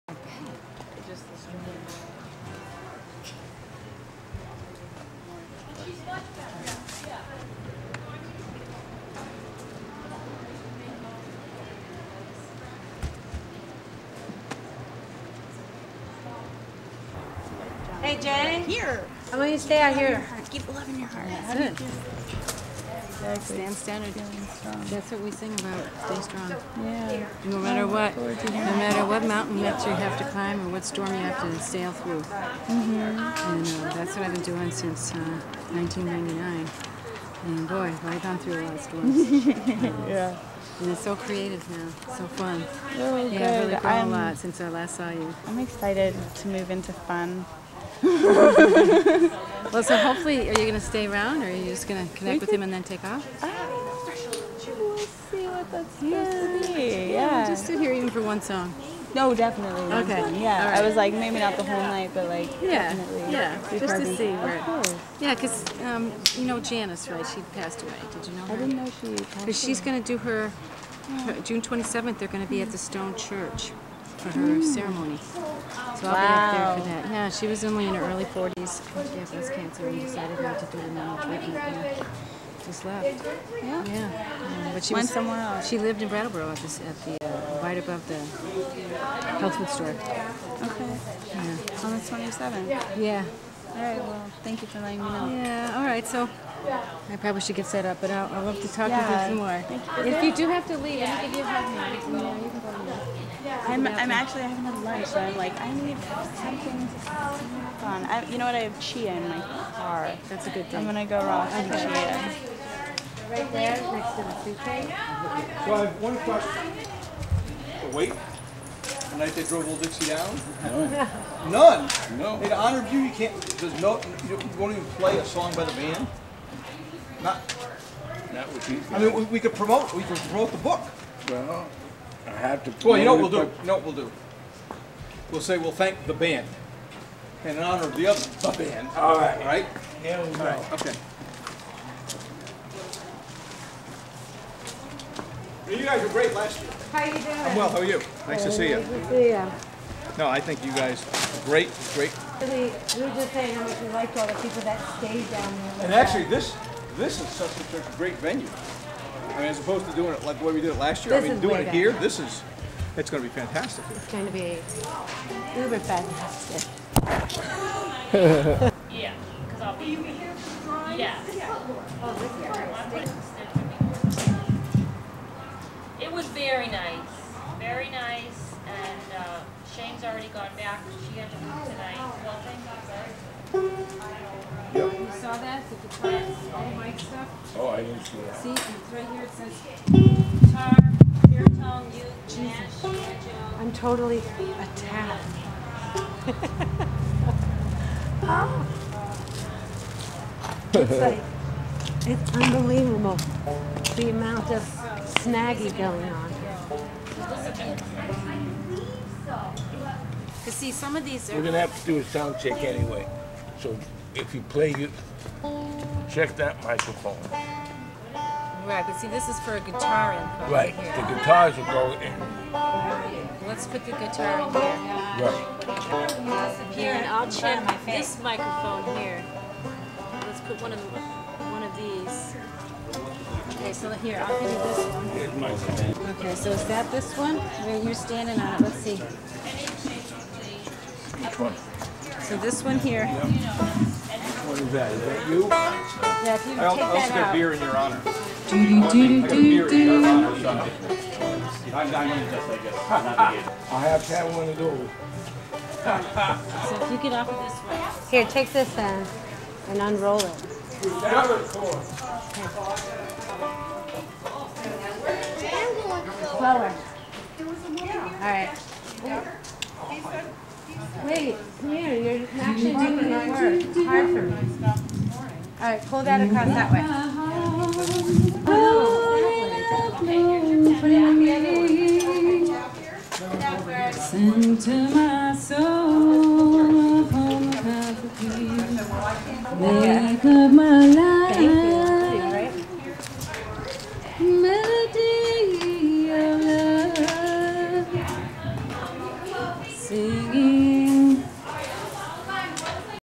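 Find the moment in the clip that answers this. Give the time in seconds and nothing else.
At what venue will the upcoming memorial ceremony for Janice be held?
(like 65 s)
72 s.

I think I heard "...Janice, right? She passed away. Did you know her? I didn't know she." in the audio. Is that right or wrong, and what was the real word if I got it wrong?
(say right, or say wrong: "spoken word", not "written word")
right.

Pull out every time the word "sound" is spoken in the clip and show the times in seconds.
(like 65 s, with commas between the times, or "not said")
212 s.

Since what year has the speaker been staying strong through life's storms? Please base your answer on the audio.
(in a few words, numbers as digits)
1999.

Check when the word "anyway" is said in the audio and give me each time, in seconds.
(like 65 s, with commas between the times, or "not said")
212 s.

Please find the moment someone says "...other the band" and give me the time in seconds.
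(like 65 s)
138 s.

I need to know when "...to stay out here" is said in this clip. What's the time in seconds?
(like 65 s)
19 s.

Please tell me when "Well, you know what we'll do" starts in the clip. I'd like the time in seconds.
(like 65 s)
132 s.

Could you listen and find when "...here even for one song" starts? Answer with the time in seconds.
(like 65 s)
57 s.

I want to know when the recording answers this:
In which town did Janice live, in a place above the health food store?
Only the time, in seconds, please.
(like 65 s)
86 s.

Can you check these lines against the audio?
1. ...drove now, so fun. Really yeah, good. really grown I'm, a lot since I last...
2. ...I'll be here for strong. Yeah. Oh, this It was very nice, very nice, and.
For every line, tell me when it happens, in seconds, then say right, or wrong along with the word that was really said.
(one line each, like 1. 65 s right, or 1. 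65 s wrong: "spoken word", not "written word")
1. 41 s wrong: "creative", not "drove"
2. 169 s wrong: "drawing", not "strong".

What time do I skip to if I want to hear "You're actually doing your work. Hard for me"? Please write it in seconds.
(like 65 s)
272 s.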